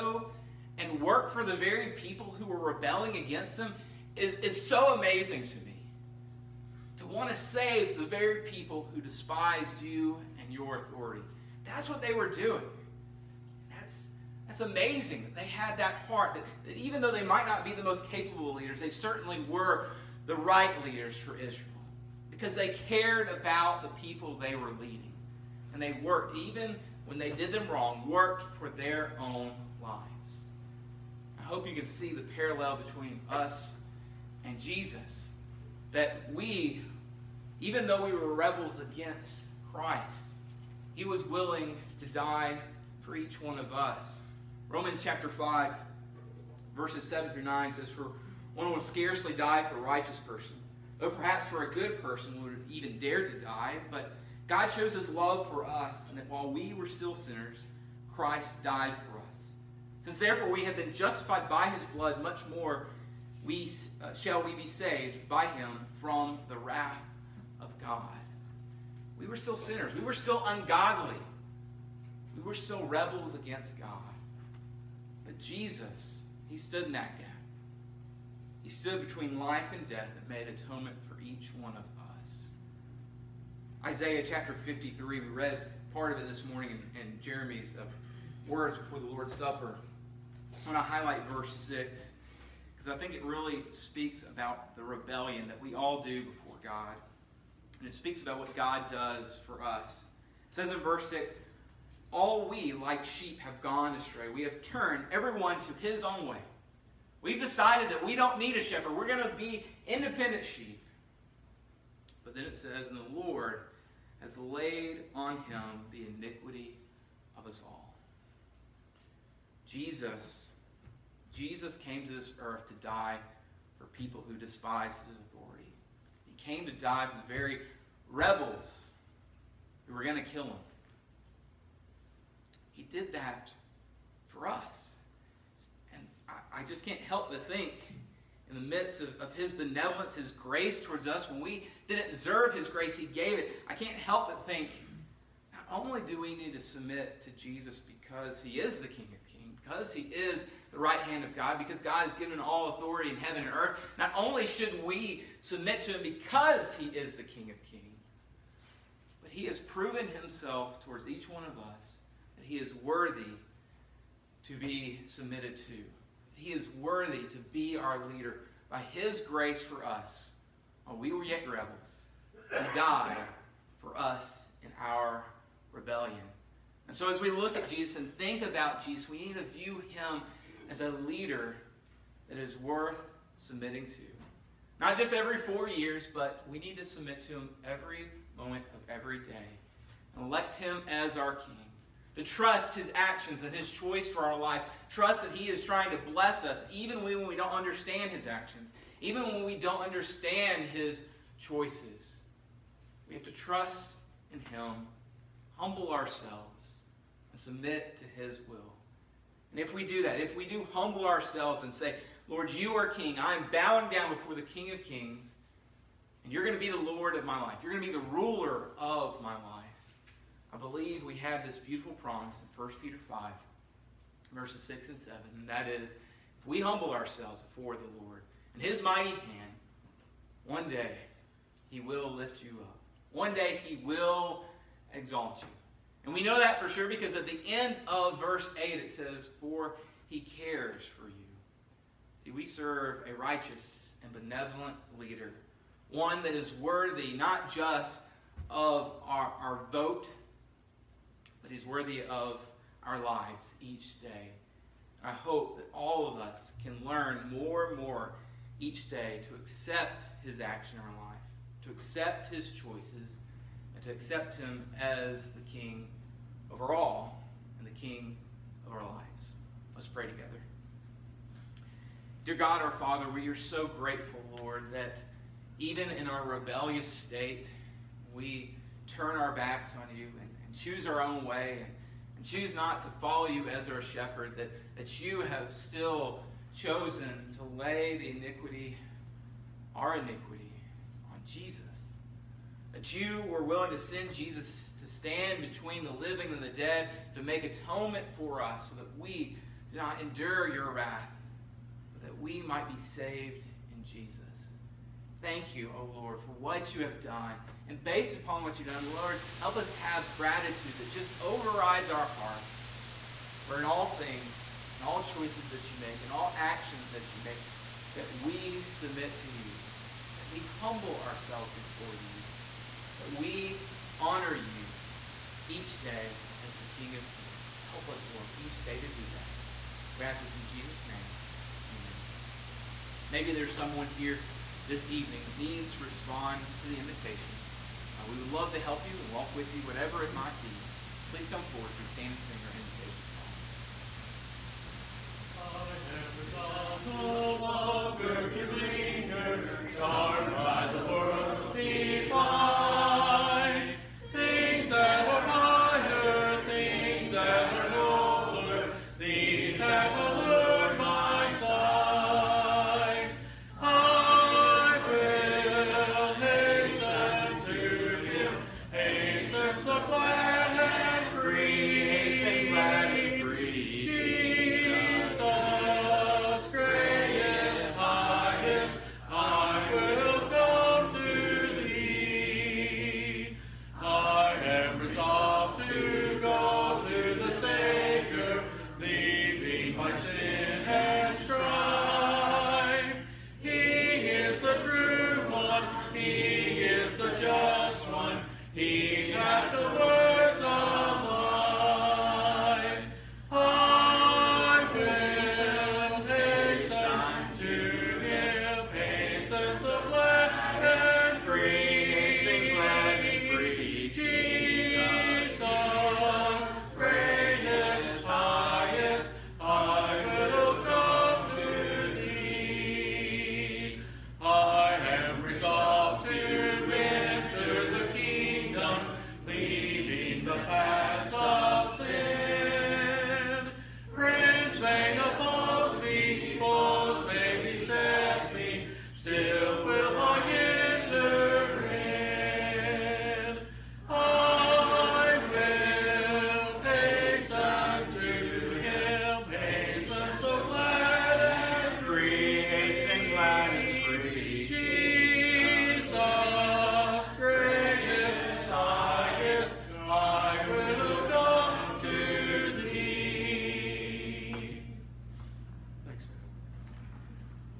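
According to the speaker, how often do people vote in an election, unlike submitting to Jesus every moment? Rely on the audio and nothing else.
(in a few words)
Every four years.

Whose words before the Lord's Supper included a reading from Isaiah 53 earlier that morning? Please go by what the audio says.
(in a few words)
Jeremy.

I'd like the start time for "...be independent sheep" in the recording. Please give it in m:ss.
1:49.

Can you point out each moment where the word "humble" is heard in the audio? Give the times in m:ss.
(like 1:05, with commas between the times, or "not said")
3:25, 3:30, 3:46, 5:20.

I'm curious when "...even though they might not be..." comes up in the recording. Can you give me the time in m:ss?
0:16.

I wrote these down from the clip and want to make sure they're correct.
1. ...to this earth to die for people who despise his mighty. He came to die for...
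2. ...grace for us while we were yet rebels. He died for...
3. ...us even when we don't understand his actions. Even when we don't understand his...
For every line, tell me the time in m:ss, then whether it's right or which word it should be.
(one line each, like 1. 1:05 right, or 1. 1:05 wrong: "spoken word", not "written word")
1. 2:02 wrong: "authority", not "mighty"
2. 2:49 right
3. 3:16 right.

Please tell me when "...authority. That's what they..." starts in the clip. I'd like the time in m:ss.
0:10.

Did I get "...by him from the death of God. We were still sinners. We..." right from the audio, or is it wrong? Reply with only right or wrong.
wrong.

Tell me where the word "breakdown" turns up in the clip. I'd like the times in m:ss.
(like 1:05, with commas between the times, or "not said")
not said.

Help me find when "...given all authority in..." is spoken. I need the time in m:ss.
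2:32.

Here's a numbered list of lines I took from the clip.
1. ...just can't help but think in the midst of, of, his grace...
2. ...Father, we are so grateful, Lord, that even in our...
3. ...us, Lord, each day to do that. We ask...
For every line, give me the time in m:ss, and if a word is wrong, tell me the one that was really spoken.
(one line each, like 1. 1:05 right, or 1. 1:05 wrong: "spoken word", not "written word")
1. 2:16 wrong: "benevolence", not "grace"
2. 4:32 right
3. 5:27 right.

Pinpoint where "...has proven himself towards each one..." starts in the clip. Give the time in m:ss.
2:39.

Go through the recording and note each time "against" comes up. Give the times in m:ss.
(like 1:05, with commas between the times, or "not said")
0:03, 0:38, 1:13.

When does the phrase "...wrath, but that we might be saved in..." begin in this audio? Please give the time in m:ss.
5:00.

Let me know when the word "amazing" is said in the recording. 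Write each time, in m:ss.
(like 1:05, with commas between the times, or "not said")
0:04, 0:14.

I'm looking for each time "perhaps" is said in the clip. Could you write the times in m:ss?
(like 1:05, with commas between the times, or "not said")
0:51.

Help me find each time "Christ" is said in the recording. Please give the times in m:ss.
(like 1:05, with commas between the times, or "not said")
0:39, 0:58.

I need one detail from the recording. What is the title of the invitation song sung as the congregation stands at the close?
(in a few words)
I Am Resolved.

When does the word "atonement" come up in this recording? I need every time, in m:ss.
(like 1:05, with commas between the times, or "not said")
1:20, 4:57.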